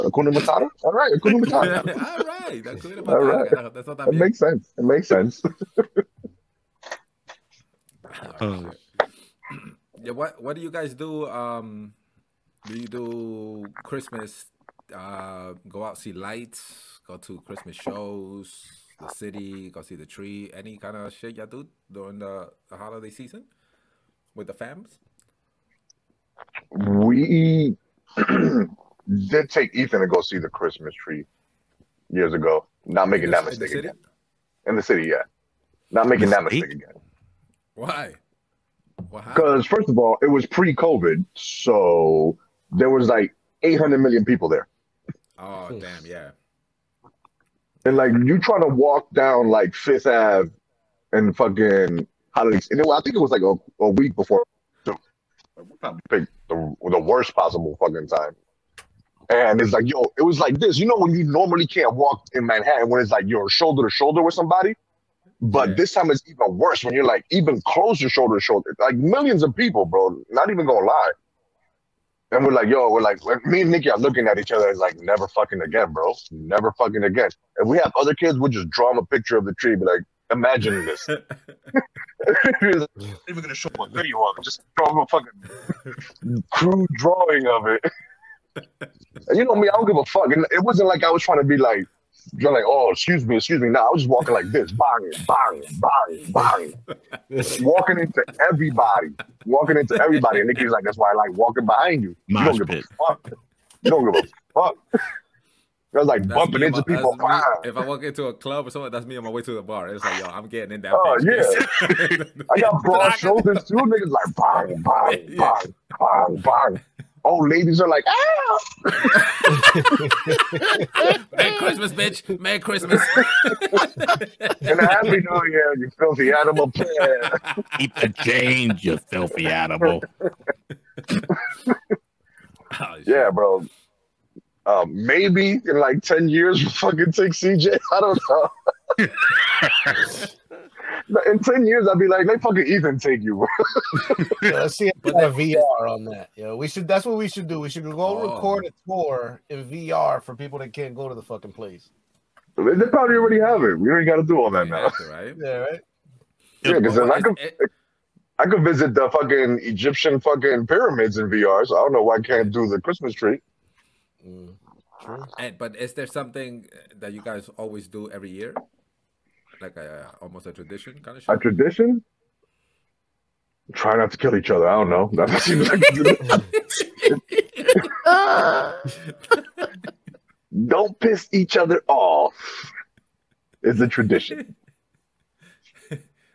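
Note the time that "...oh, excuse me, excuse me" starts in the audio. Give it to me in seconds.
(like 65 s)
92 s.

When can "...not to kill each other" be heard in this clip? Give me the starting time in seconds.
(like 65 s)
173 s.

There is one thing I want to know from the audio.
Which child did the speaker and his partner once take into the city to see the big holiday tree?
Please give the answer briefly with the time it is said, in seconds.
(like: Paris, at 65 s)
Ethan, at 29 s.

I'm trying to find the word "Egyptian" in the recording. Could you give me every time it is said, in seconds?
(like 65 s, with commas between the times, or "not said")
159 s.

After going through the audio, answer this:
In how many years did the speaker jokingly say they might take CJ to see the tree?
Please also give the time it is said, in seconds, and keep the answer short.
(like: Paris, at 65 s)
10, at 136 s.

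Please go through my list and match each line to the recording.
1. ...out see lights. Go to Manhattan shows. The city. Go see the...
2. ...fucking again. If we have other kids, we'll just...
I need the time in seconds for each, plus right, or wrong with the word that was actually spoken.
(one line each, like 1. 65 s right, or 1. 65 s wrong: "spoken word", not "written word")
1. 15 s wrong: "Christmas", not "Manhattan"
2. 76 s right.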